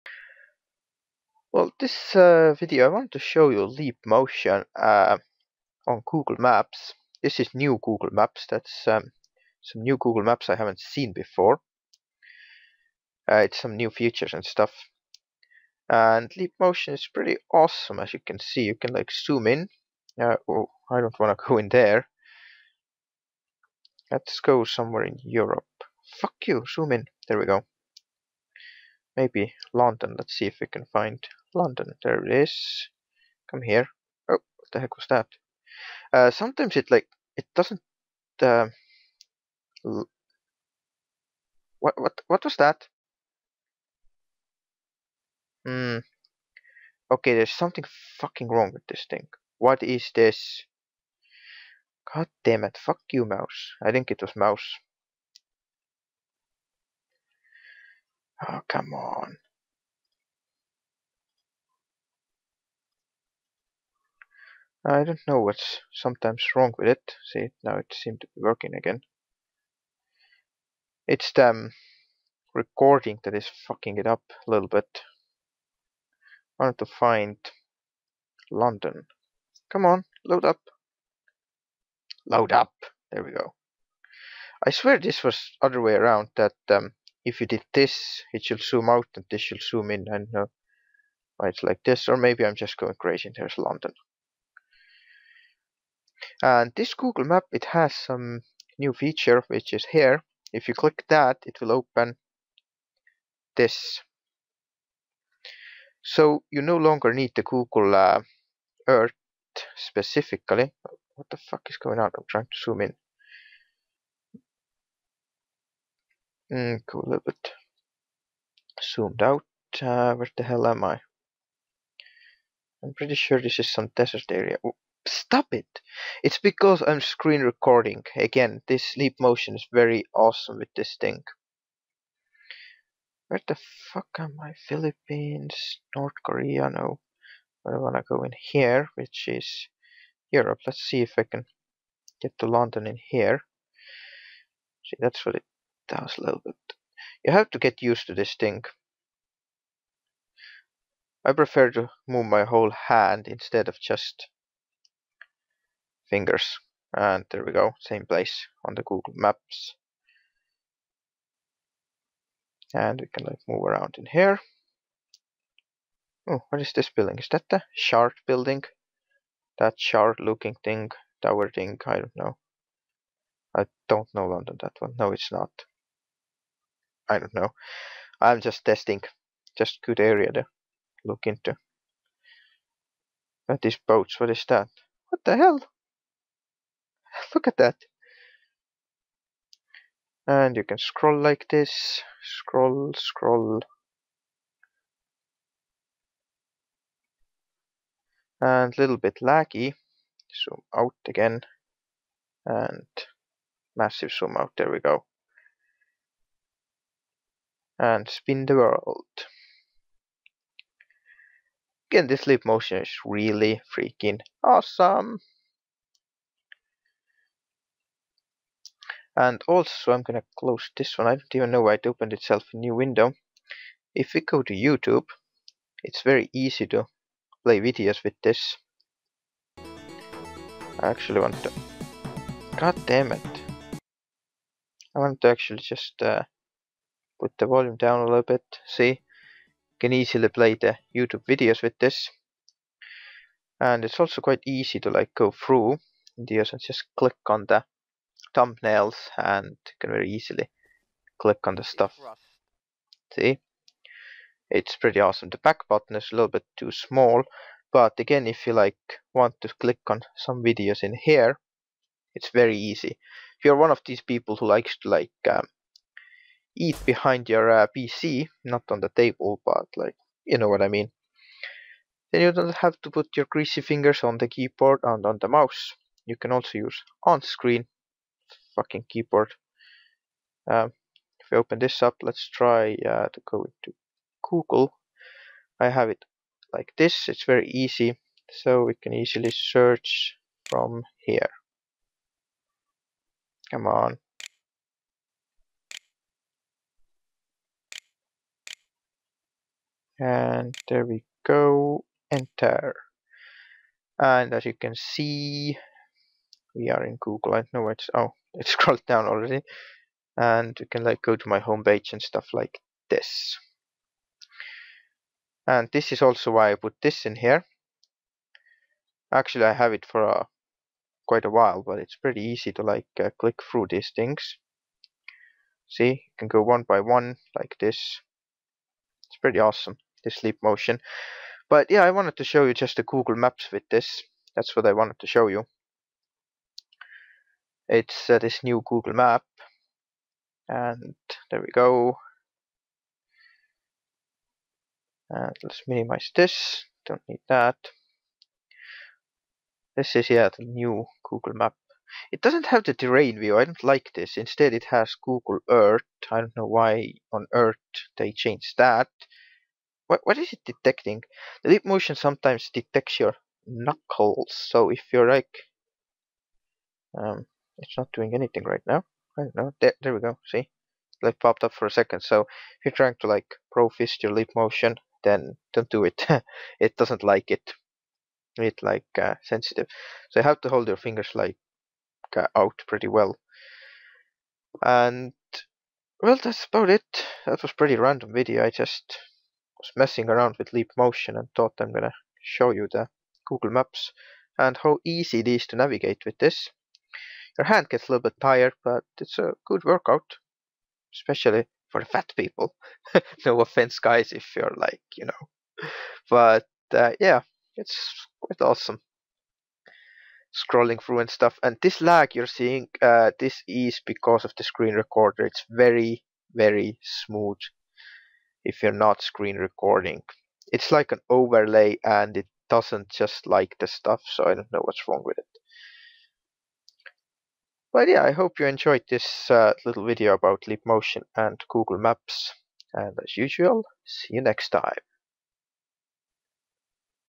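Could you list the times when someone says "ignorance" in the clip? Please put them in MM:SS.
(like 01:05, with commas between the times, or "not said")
not said.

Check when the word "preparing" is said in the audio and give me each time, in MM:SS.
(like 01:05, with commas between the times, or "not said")
not said.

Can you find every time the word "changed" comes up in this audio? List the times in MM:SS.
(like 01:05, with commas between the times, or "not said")
05:58.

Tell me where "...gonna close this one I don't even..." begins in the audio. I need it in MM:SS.
03:40.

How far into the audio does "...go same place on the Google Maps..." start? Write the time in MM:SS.
02:37.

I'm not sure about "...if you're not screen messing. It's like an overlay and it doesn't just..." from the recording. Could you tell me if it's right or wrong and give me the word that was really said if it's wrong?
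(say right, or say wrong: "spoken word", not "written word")
wrong: "recording", not "messing".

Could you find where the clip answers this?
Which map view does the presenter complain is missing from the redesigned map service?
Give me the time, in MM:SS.
05:52.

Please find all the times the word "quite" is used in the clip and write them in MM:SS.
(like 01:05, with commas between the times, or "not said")
04:04, 05:21, 06:48.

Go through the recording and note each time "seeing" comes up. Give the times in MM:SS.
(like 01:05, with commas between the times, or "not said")
06:52.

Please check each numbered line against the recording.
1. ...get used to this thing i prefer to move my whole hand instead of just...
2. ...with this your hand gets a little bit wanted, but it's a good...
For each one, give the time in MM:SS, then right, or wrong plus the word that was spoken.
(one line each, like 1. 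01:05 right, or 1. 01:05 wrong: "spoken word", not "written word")
1. 02:27 right
2. 06:36 wrong: "tired", not "wanted".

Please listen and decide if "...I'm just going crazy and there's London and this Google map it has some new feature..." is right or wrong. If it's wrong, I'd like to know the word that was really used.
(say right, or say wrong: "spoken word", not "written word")
right.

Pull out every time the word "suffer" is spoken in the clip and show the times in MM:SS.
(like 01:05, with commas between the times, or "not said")
not said.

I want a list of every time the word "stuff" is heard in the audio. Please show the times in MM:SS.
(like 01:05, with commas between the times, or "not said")
00:14, 04:11, 05:12, 06:51, 07:03.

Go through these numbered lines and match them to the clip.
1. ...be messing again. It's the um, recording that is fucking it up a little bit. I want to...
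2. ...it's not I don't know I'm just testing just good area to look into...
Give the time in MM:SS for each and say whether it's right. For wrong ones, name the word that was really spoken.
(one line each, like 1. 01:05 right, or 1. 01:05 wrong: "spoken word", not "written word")
1. 01:08 wrong: "working", not "messing"
2. 02:55 right.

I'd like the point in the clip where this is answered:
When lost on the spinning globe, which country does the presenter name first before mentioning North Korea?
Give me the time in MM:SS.
02:14.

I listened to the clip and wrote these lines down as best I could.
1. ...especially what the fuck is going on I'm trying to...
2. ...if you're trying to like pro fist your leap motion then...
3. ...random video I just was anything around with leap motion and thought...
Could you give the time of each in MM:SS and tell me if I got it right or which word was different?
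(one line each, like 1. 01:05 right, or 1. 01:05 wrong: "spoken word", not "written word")
1. 01:49 wrong: "specifically", not "especially"
2. 06:12 right
3. 06:27 wrong: "messing", not "anything".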